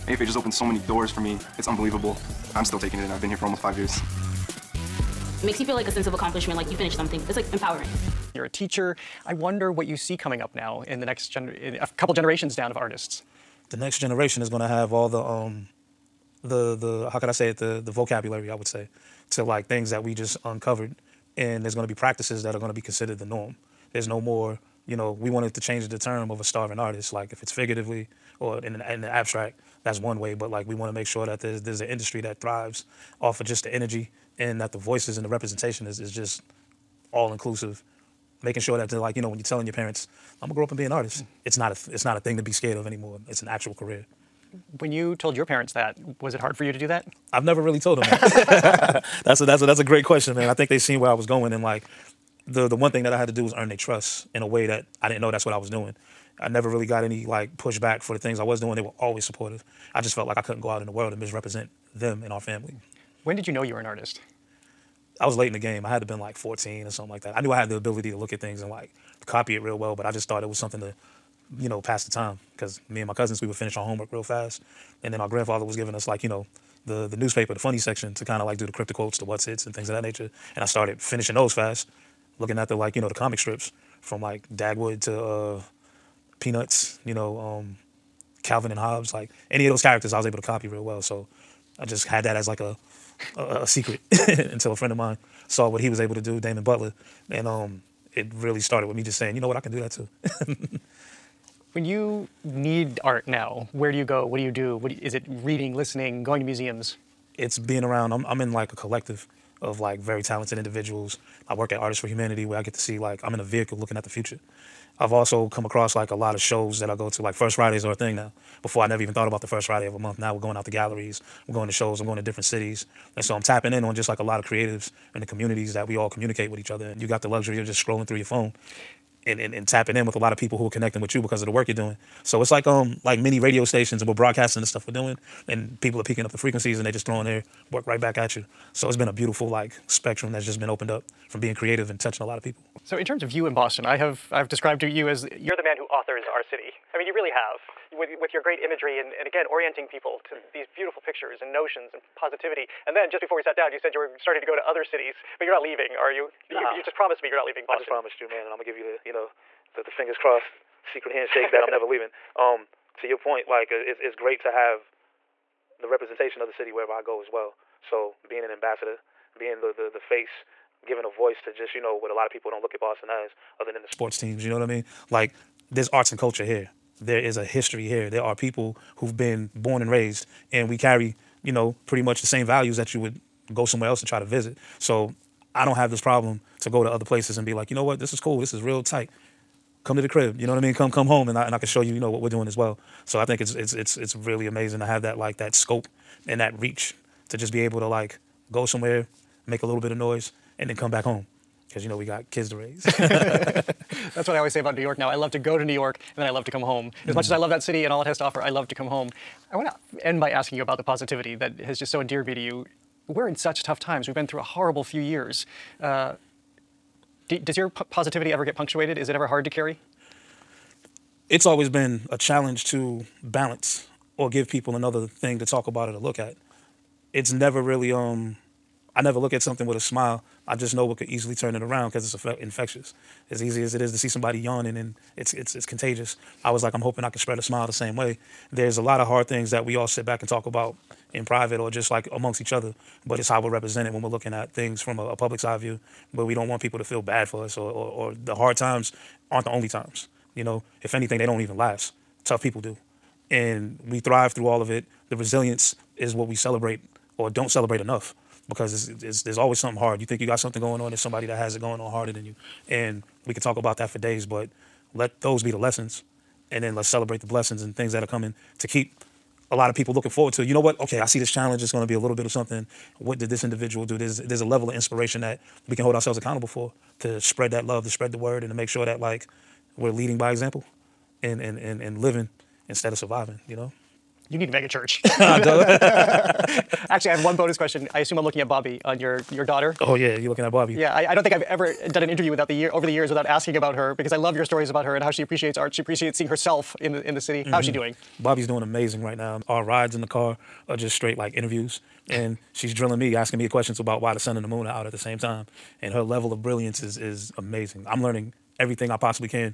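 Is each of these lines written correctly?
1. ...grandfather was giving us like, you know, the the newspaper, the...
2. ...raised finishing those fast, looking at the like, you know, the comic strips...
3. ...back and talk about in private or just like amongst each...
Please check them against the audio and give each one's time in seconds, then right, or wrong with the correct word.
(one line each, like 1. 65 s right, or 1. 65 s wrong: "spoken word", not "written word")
1. 75 s right
2. 80 s wrong: "started", not "raised"
3. 240 s right.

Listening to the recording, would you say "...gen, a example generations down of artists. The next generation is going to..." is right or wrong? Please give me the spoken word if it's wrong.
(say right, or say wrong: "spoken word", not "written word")
wrong: "couple", not "example".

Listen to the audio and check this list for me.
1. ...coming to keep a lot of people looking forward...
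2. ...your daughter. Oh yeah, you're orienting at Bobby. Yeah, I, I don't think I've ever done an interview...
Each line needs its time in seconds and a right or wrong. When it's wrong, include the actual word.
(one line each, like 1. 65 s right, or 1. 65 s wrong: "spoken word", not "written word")
1. 268 s right
2. 289 s wrong: "looking", not "orienting".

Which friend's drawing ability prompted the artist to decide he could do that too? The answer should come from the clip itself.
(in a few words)
Damon Butler.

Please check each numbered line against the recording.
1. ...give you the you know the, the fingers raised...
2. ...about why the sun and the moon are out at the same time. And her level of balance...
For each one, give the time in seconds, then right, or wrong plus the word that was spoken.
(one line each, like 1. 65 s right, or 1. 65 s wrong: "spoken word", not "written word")
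1. 158 s wrong: "crossed", not "raised"
2. 303 s wrong: "brilliance", not "balance".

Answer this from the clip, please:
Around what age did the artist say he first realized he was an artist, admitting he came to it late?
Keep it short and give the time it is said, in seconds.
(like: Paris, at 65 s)
14, at 66 s.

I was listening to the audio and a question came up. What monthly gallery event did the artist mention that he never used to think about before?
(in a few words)
First Fridays.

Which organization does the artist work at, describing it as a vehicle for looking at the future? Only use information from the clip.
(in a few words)
Artists for Humanity.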